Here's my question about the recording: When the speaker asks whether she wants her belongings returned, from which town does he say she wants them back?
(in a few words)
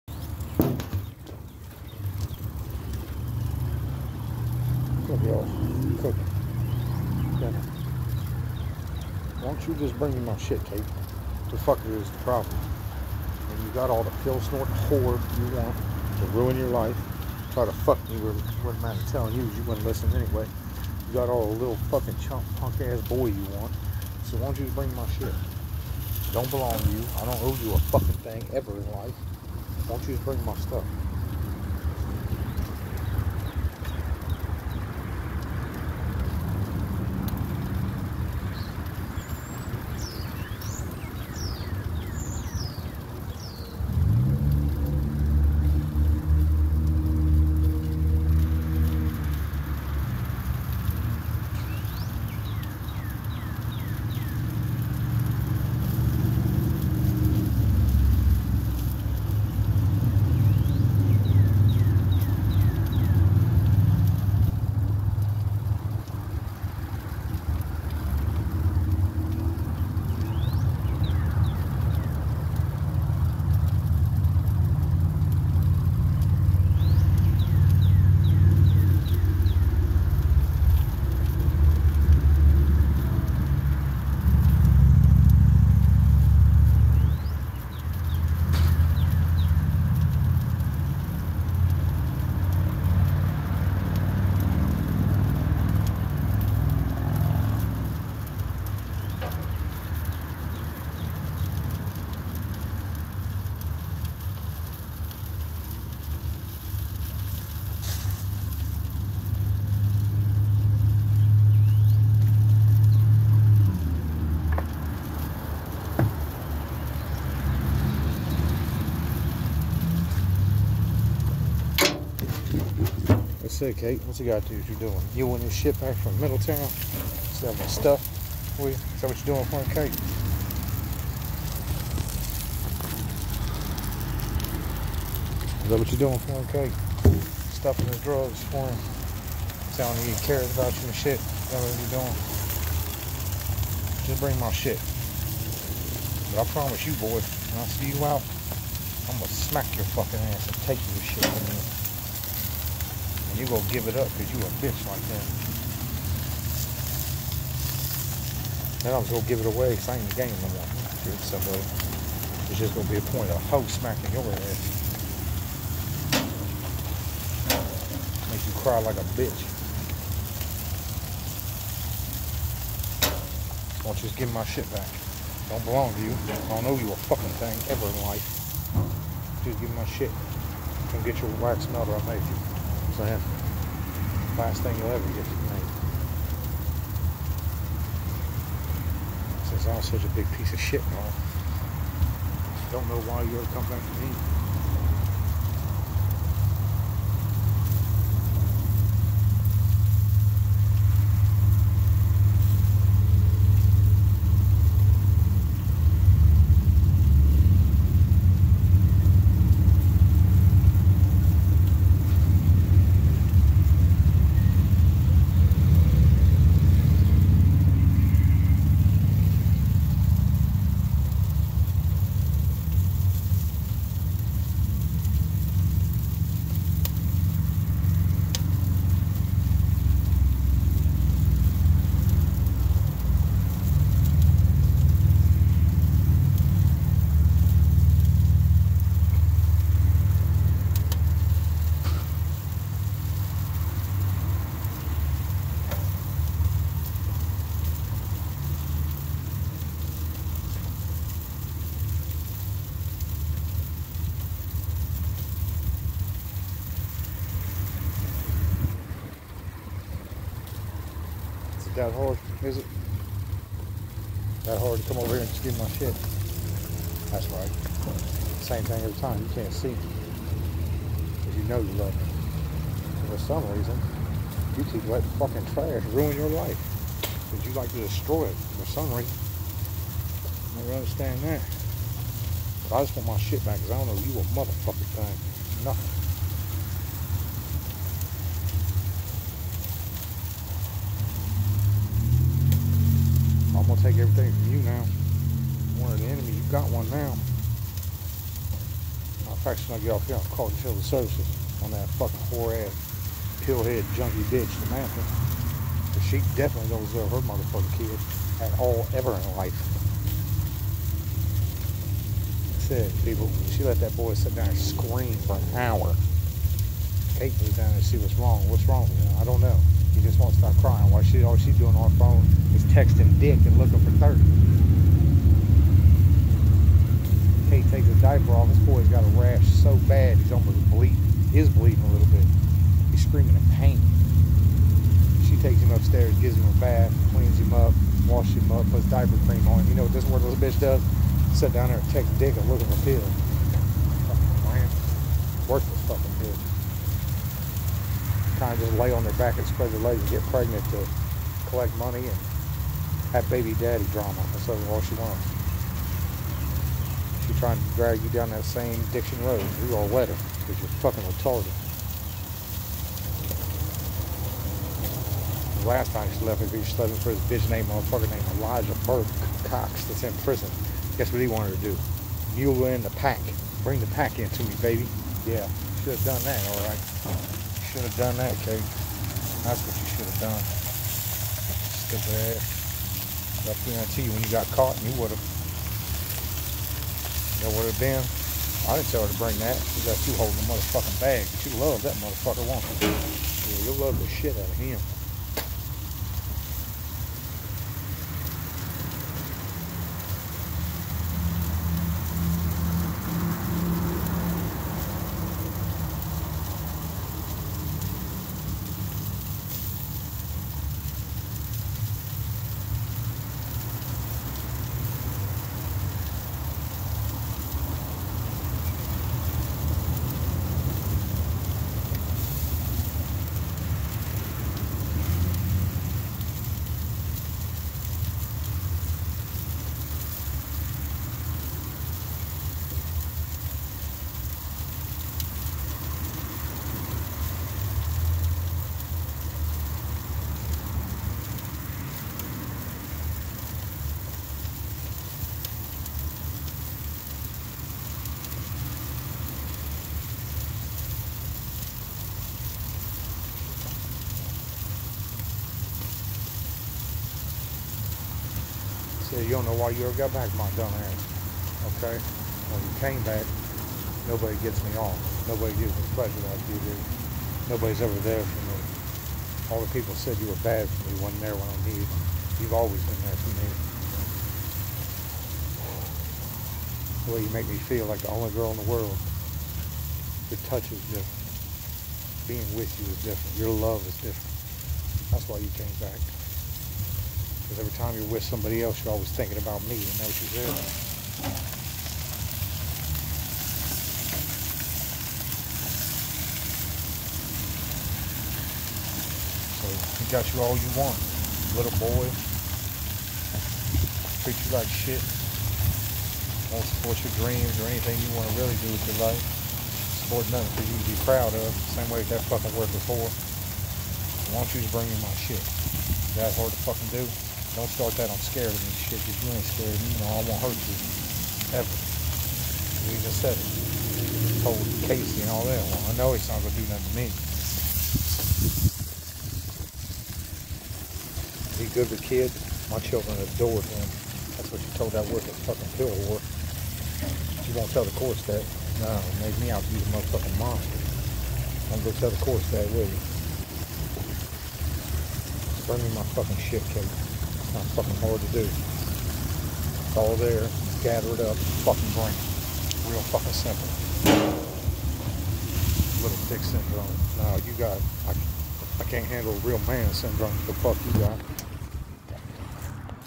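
Middletown.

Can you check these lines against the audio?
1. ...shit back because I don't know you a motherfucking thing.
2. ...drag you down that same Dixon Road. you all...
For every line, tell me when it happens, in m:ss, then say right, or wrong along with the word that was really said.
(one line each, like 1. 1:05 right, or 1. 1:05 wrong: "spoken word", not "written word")
1. 4:43 right
2. 5:57 right.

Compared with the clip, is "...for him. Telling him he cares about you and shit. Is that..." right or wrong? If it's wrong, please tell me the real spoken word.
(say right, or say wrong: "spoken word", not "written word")
right.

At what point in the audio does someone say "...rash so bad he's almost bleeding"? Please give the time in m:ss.
5:29.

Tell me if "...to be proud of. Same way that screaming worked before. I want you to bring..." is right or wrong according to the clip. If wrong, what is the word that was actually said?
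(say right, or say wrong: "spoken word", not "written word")
wrong: "fucking", not "screaming".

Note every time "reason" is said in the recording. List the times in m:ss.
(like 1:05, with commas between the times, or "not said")
4:33, 4:38.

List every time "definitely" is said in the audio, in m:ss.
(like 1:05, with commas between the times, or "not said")
5:06.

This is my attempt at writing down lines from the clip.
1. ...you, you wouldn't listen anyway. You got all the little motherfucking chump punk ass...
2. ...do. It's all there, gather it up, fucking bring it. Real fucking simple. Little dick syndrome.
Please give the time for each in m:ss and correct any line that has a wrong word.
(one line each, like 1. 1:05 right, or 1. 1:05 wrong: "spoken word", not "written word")
1. 0:19 wrong: "fucking", not "motherfucking"
2. 9:08 right.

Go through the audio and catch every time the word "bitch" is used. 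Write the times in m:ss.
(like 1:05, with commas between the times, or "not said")
2:34, 2:49, 5:04, 5:40, 6:07.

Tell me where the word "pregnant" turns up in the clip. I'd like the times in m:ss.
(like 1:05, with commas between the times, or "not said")
5:50.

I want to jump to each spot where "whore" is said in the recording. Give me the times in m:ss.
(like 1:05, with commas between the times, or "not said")
0:14, 5:02, 8:56.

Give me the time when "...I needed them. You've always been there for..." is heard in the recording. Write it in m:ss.
7:51.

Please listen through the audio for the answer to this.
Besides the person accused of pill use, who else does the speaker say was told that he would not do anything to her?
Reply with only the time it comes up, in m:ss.
8:44.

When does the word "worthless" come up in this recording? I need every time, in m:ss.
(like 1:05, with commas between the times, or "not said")
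5:45, 8:55.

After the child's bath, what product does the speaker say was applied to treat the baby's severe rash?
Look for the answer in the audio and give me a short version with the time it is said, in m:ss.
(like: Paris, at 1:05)
diaper cream, at 5:38.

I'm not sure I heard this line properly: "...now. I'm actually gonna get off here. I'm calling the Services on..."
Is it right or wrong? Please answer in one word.
right.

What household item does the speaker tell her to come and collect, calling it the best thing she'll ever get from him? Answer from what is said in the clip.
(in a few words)
wax melter.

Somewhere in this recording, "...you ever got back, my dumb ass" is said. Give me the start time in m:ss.
7:39.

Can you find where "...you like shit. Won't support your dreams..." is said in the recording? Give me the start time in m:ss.
8:24.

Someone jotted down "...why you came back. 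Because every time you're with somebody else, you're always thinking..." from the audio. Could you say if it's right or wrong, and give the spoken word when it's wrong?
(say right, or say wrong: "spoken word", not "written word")
right.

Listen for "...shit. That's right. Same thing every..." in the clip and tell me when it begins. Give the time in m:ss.
4:25.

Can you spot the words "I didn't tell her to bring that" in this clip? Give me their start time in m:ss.
6:28.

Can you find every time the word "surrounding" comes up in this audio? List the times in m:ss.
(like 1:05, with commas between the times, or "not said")
not said.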